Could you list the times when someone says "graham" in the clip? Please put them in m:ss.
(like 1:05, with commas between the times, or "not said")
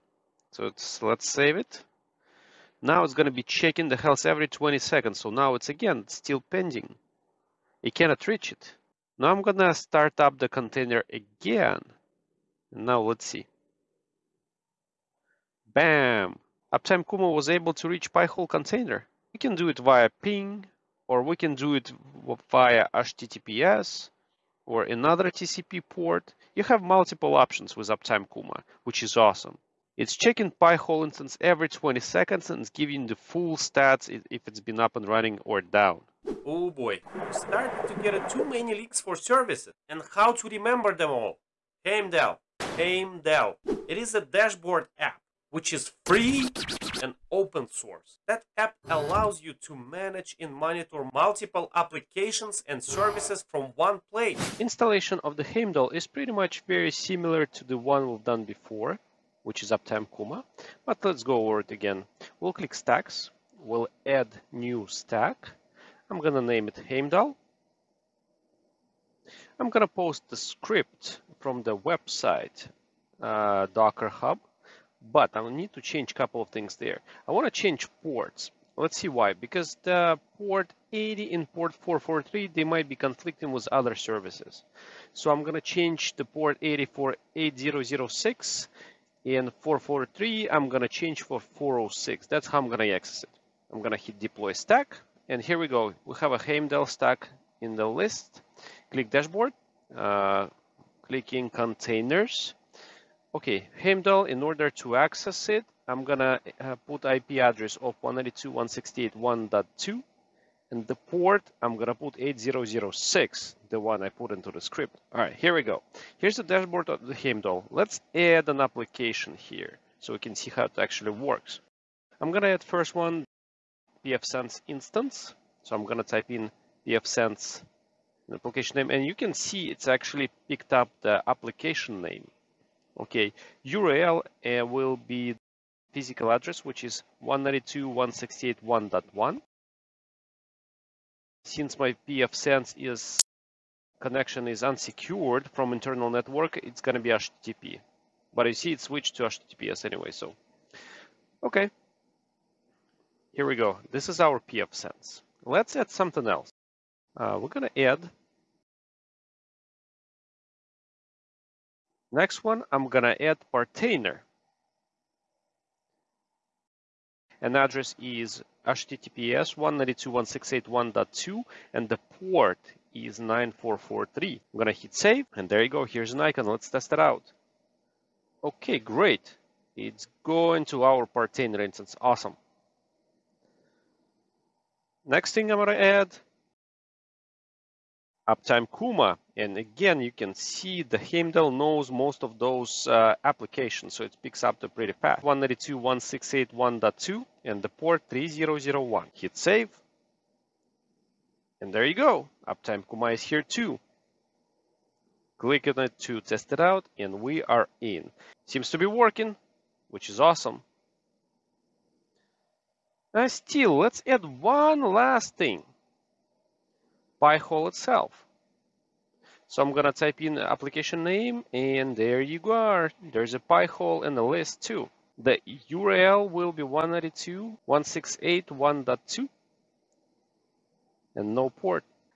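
not said.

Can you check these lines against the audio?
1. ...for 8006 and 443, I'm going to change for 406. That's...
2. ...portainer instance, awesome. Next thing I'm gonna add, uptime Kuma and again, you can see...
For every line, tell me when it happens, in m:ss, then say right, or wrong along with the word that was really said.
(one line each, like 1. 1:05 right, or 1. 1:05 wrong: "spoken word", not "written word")
1. 1:26 right
2. 3:01 right.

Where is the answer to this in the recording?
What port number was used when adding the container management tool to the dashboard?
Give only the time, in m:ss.
2:53.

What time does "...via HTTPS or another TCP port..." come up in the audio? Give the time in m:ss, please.
0:22.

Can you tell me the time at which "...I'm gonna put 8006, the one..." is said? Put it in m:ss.
1:51.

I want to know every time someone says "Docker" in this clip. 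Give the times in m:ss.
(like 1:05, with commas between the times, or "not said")
1:13.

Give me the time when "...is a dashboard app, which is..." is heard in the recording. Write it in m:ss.
0:43.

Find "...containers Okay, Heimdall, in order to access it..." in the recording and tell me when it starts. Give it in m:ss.
1:41.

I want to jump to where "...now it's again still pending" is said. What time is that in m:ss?
0:05.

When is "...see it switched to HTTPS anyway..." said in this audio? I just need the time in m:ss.
2:28.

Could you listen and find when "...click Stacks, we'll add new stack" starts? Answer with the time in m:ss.
1:02.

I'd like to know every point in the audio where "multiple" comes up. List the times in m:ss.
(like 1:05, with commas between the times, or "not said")
0:26, 0:51.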